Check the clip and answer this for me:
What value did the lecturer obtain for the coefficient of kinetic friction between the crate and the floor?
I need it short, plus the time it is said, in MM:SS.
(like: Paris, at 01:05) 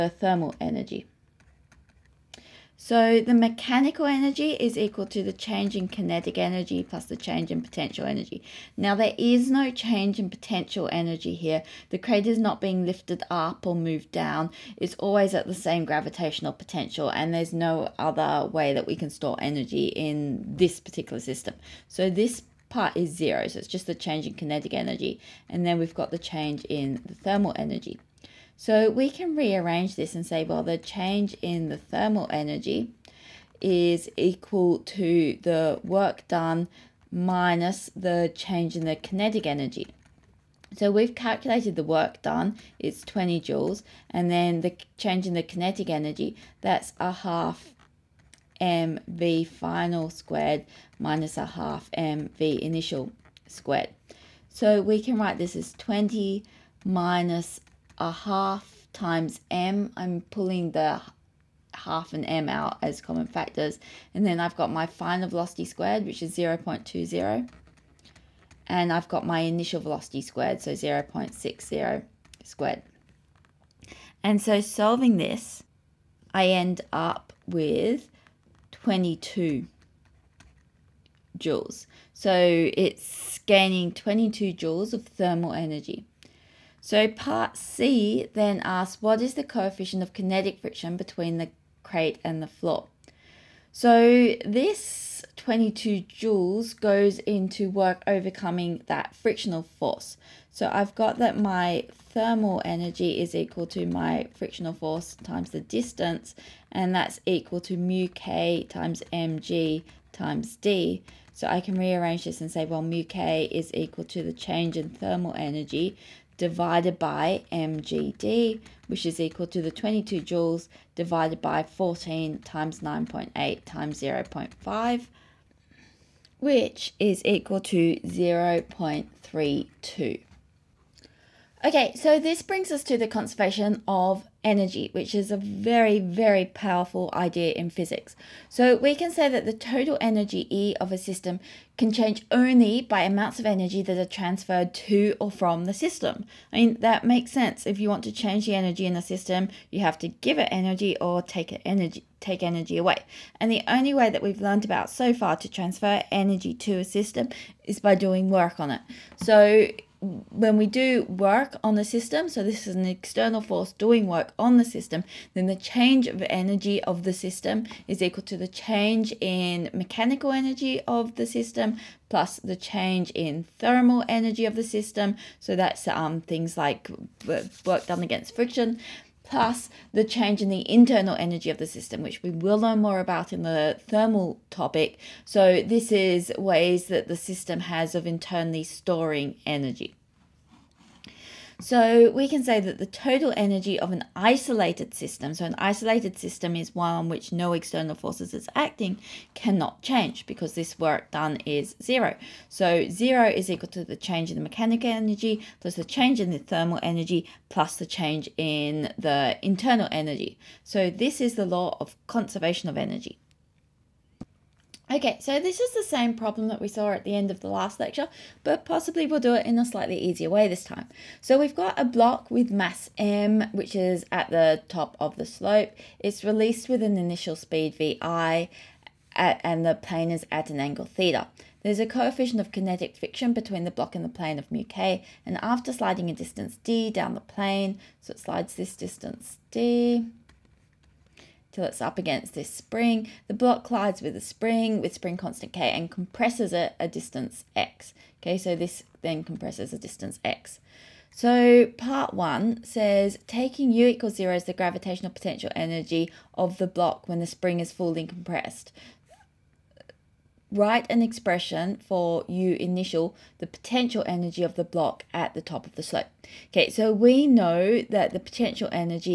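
0.32, at 02:07.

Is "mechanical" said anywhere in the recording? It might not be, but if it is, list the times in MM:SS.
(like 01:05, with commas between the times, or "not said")
00:03, 02:49, 03:24.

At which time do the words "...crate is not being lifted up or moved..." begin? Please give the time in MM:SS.
00:11.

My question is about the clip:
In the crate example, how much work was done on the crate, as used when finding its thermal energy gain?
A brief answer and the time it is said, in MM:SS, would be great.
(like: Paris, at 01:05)
20 joules, at 00:42.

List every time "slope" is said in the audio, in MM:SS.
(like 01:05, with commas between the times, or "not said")
03:45, 04:25.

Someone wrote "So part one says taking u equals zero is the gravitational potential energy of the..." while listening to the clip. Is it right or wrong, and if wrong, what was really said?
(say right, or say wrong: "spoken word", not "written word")
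right.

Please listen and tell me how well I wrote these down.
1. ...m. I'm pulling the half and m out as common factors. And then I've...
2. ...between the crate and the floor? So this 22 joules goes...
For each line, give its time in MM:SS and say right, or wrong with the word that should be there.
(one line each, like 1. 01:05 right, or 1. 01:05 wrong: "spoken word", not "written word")
1. 00:59 right
2. 01:30 right.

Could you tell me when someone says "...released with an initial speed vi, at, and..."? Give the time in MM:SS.
03:46.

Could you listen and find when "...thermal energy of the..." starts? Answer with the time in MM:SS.
02:53.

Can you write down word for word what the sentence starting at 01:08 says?
And I've got my initial velocity squared, so 0 0.60 squared.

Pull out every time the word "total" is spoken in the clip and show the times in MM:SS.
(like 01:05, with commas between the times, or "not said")
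02:19, 03:12.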